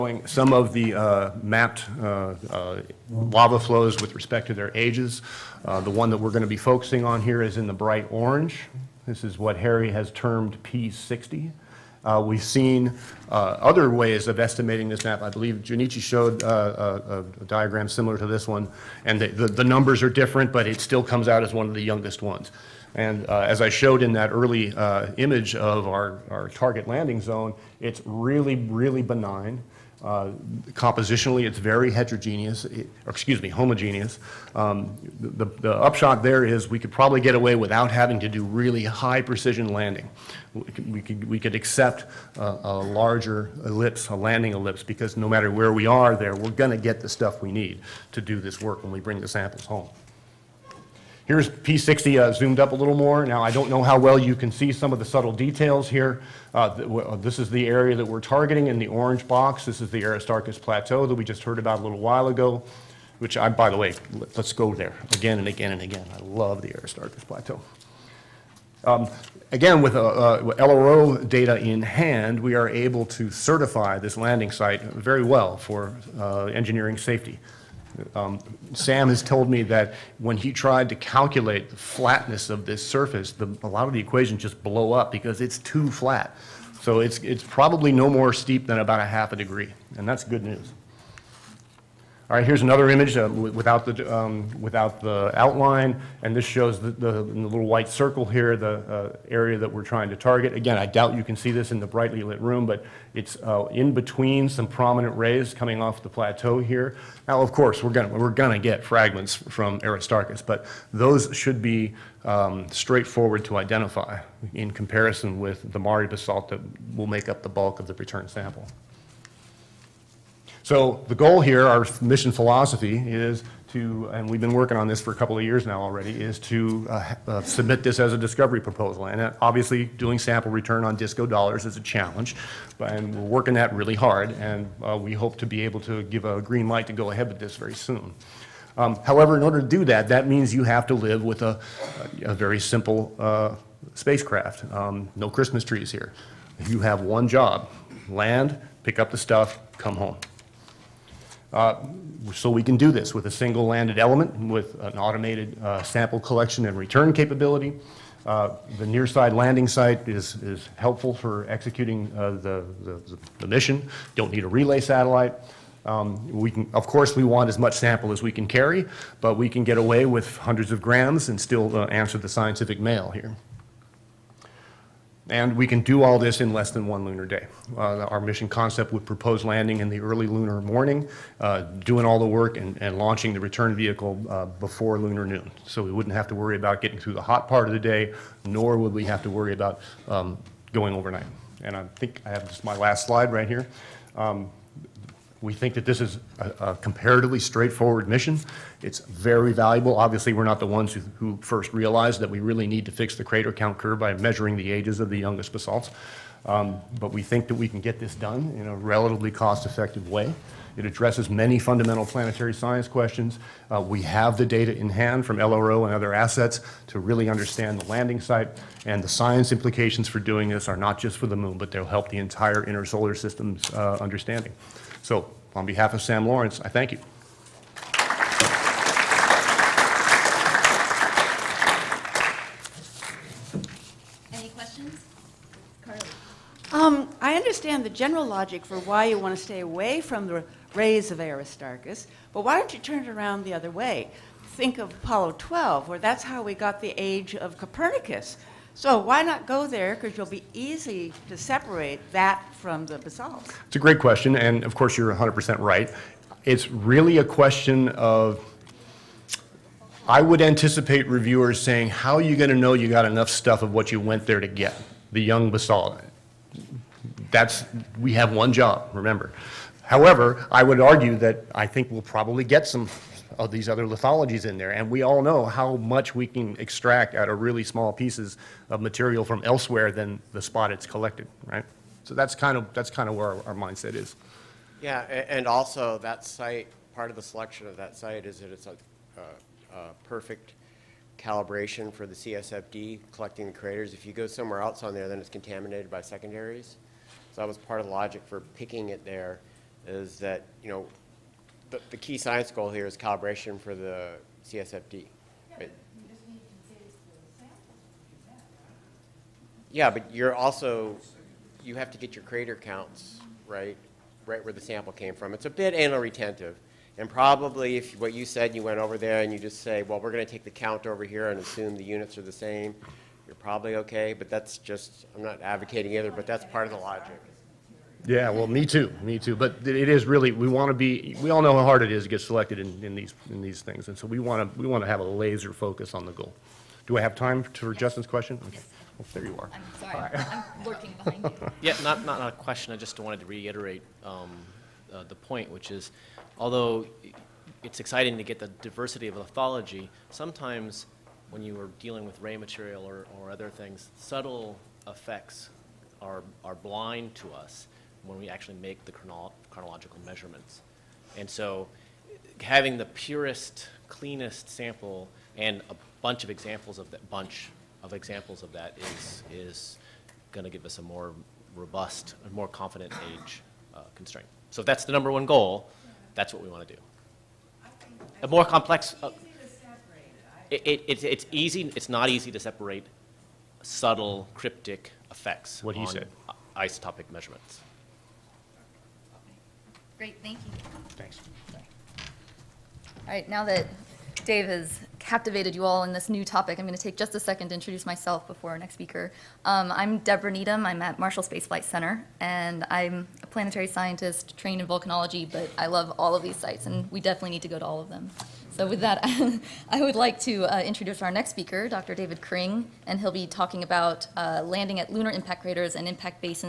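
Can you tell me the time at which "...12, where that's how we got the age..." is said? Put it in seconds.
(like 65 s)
245 s.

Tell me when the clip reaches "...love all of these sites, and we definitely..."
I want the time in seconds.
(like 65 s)
405 s.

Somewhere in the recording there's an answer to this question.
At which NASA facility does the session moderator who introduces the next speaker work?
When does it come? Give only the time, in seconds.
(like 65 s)
400 s.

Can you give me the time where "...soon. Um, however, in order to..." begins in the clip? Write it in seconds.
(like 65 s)
137 s.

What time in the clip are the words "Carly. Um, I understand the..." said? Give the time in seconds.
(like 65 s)
235 s.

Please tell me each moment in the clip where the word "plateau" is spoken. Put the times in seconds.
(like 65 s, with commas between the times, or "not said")
60 s, 67 s, 106 s.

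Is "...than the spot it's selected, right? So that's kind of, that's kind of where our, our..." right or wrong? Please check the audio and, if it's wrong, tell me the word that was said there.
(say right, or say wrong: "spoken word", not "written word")
wrong: "collected", not "selected".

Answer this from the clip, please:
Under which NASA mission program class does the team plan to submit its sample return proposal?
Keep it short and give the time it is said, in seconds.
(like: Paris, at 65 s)
Discovery, at 128 s.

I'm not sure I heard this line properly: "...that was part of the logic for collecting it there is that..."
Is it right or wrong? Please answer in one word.
wrong.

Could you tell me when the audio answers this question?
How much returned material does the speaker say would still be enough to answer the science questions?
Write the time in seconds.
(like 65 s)
170 s.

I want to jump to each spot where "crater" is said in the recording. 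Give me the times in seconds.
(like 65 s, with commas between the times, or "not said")
203 s, 293 s, 312 s, 415 s.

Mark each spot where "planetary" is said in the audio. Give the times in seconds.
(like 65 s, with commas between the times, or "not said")
212 s, 403 s.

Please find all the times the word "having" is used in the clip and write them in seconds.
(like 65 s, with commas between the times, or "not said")
37 s, 362 s.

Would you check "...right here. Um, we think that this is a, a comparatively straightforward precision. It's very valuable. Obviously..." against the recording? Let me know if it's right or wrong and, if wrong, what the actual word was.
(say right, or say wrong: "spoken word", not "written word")
wrong: "mission", not "precision".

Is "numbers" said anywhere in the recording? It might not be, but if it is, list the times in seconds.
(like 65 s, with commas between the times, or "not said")
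19 s, 374 s.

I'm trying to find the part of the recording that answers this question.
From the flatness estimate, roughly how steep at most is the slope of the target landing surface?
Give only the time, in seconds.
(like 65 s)
89 s.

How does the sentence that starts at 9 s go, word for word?
This is what Harry has termed P60.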